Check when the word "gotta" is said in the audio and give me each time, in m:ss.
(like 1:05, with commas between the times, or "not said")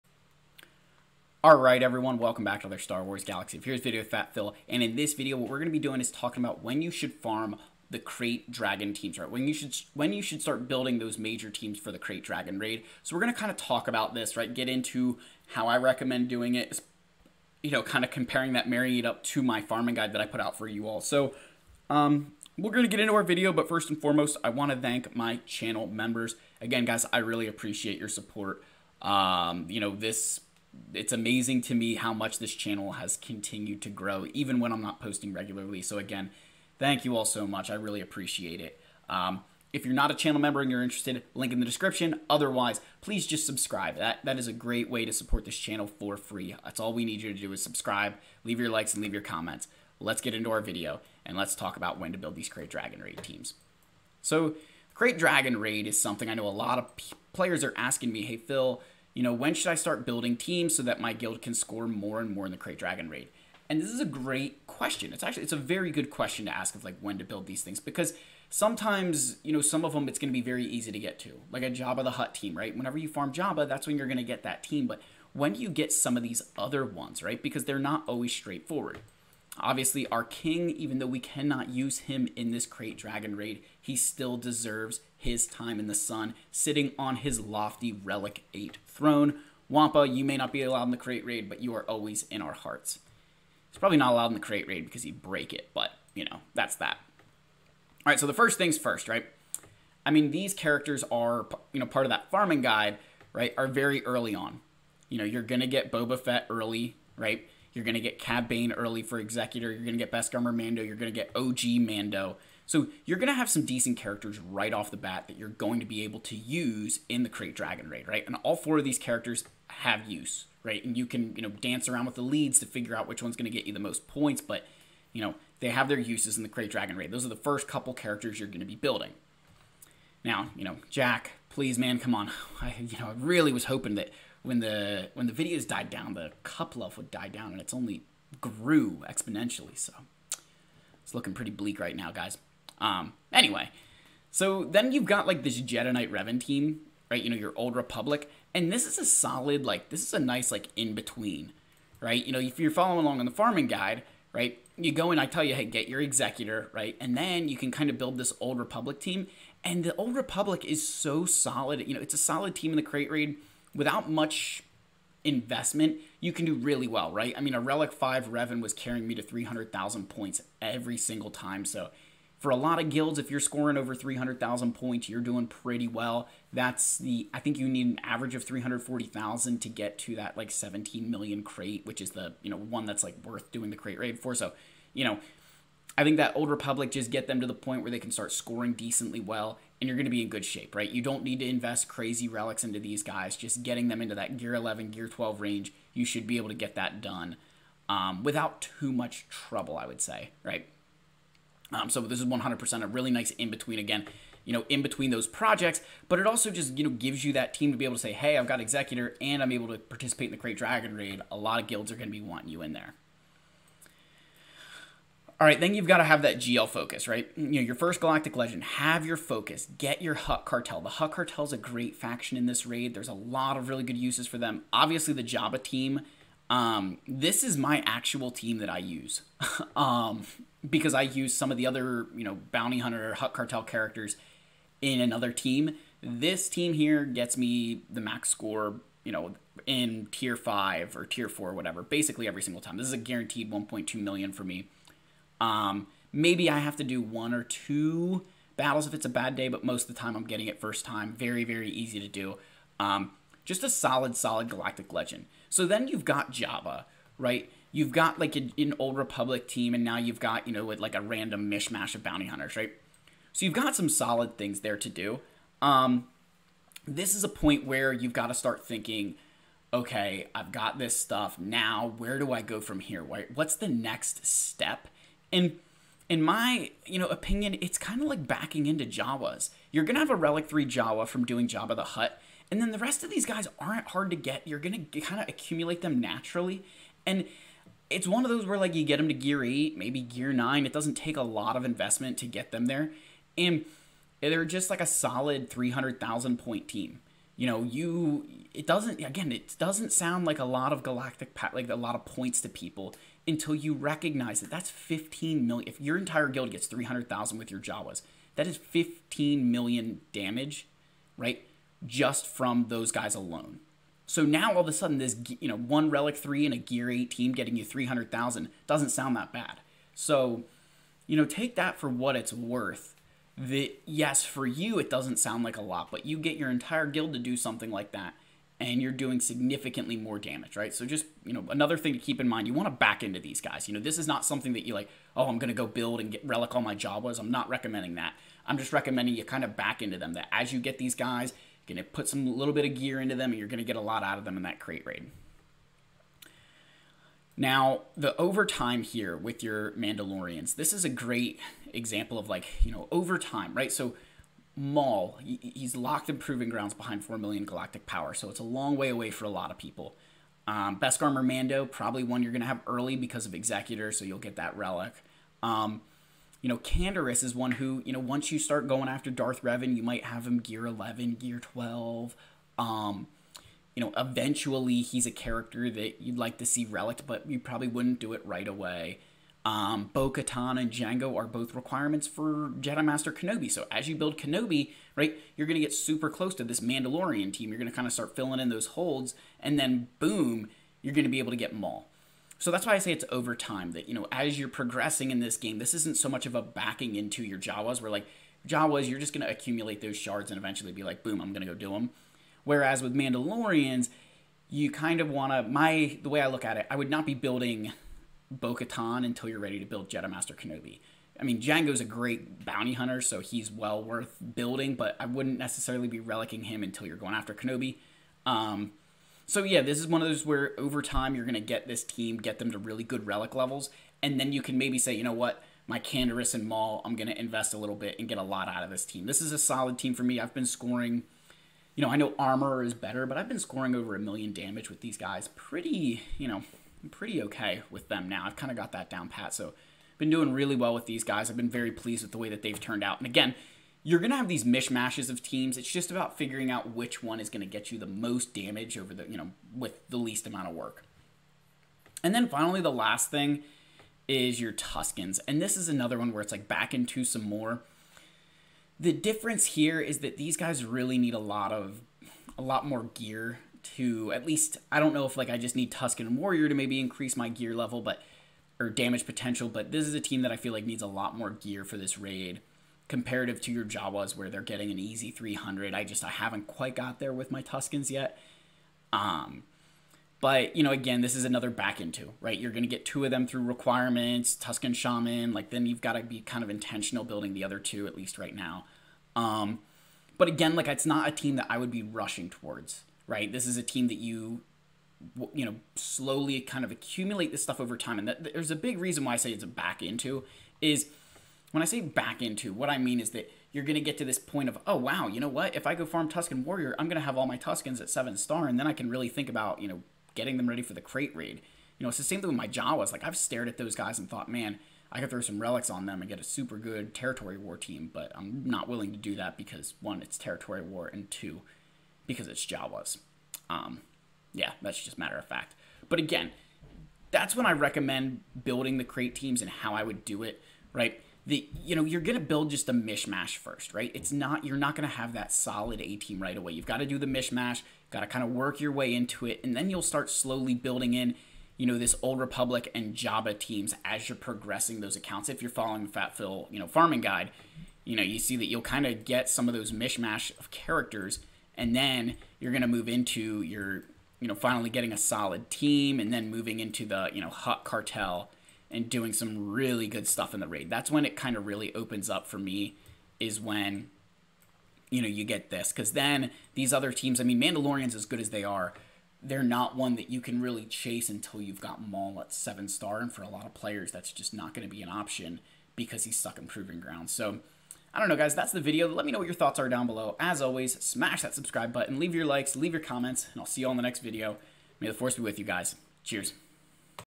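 8:05, 8:57.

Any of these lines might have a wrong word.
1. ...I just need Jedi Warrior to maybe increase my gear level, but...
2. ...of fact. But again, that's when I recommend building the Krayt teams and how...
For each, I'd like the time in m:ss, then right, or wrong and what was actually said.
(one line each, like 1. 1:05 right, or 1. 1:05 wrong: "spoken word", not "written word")
1. 7:45 wrong: "Tusken", not "Jedi"
2. 8:45 right.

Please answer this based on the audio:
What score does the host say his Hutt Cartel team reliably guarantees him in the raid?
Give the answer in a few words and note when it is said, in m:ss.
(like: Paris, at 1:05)
1.2 million, at 4:03.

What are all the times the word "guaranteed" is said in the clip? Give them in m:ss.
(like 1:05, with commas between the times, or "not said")
4:02.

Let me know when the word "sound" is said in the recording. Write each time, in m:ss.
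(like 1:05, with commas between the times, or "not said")
4:59, 5:18, 5:25.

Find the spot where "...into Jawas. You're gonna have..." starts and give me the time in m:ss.
4:38.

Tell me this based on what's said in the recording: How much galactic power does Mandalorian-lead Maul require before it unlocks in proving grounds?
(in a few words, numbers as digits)
4 million.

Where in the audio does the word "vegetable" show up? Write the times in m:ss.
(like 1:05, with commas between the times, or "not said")
not said.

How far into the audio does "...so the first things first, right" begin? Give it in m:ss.
1:38.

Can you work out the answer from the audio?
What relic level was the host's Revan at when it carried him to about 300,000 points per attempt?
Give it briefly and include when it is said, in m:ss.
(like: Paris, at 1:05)
Relic 5, at 2:47.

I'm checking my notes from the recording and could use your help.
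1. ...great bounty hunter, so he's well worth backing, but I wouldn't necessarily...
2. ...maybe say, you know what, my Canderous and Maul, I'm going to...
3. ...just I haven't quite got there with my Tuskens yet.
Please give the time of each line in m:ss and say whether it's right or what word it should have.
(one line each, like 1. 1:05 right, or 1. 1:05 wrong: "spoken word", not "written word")
1. 6:51 wrong: "building", not "backing"
2. 7:04 right
3. 7:55 right.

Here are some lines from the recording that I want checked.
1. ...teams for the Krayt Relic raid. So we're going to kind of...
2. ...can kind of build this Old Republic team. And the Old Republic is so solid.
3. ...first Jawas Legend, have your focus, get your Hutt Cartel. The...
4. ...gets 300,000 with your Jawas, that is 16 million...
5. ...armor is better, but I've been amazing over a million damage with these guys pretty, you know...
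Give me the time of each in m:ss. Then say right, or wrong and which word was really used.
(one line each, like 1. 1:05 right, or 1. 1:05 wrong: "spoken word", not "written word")
1. 0:11 wrong: "Dragon", not "Relic"
2. 2:37 right
3. 3:37 wrong: "Galactic", not "Jawas"
4. 5:06 wrong: "15", not "16"
5. 7:12 wrong: "scoring", not "amazing".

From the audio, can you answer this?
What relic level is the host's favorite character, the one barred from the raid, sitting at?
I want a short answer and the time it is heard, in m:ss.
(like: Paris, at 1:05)
Relic 8, at 1:27.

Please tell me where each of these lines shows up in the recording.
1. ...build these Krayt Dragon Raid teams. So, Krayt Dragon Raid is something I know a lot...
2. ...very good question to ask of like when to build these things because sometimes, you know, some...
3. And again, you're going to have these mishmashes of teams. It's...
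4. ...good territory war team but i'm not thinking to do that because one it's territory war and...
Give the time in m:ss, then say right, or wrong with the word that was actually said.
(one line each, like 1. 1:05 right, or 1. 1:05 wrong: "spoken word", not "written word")
1. 0:52 right
2. 1:05 right
3. 7:22 right
4. 8:36 wrong: "willing", not "thinking".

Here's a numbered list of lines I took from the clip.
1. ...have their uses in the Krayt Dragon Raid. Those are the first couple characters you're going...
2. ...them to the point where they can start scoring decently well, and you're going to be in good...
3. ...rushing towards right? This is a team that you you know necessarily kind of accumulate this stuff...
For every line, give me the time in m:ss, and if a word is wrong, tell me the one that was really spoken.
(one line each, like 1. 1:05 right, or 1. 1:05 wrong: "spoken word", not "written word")
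1. 2:05 right
2. 3:07 right
3. 8:11 wrong: "slowly", not "necessarily".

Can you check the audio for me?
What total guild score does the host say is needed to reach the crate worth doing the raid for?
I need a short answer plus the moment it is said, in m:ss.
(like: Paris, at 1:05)
17 million, at 3:00.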